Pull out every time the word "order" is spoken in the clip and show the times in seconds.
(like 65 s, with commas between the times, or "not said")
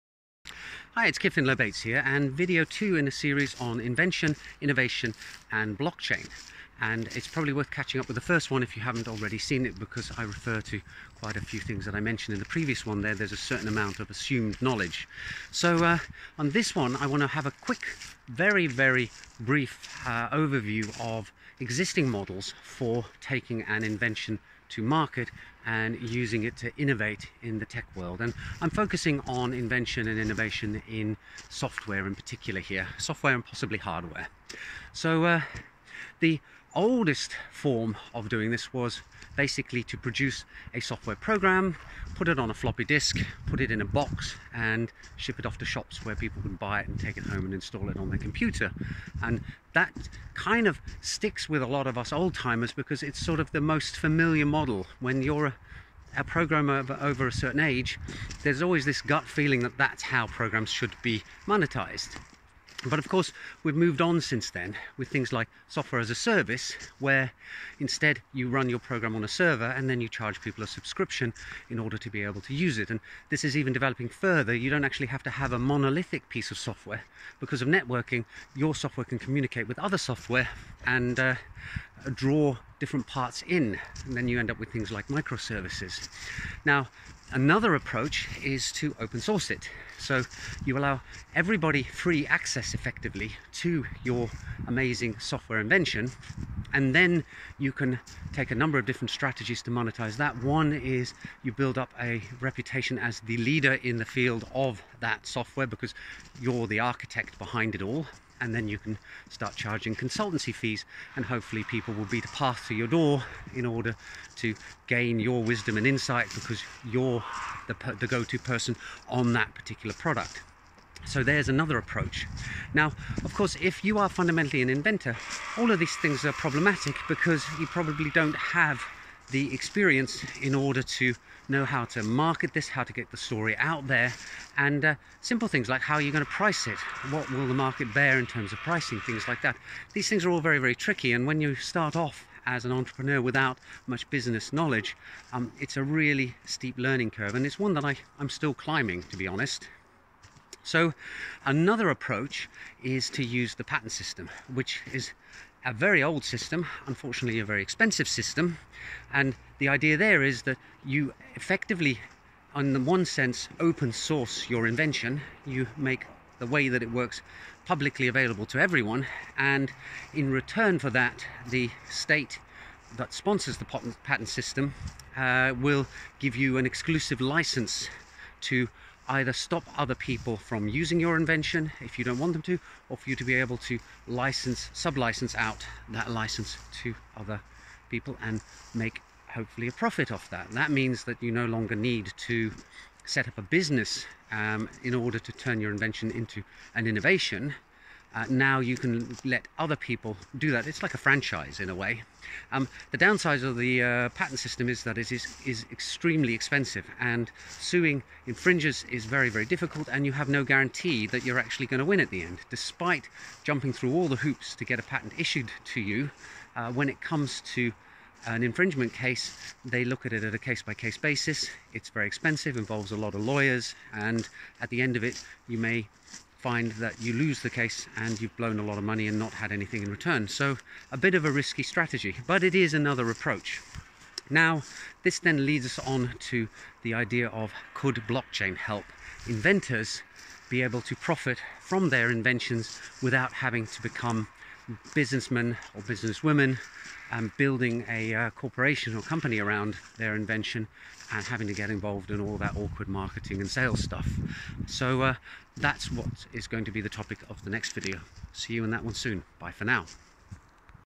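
71 s, 113 s, 130 s, 194 s.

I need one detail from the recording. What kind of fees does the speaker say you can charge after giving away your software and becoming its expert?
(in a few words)
consultancy fees.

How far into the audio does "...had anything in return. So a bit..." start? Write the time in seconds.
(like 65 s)
229 s.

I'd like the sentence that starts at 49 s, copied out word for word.
And that kind of sticks with a lot of us old timers because it's sort of the most familiar model.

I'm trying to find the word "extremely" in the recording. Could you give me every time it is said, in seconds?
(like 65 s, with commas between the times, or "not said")
205 s.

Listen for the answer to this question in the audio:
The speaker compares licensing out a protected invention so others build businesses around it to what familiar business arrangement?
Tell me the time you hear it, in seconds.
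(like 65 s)
200 s.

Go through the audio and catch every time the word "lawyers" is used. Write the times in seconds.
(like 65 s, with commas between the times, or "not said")
223 s.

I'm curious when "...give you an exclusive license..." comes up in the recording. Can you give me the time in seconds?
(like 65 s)
176 s.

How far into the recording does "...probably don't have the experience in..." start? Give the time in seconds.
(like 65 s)
127 s.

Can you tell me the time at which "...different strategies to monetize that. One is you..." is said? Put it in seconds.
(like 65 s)
98 s.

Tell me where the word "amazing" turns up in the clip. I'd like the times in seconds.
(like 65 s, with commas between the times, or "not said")
94 s.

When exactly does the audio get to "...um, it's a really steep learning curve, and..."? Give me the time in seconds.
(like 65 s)
145 s.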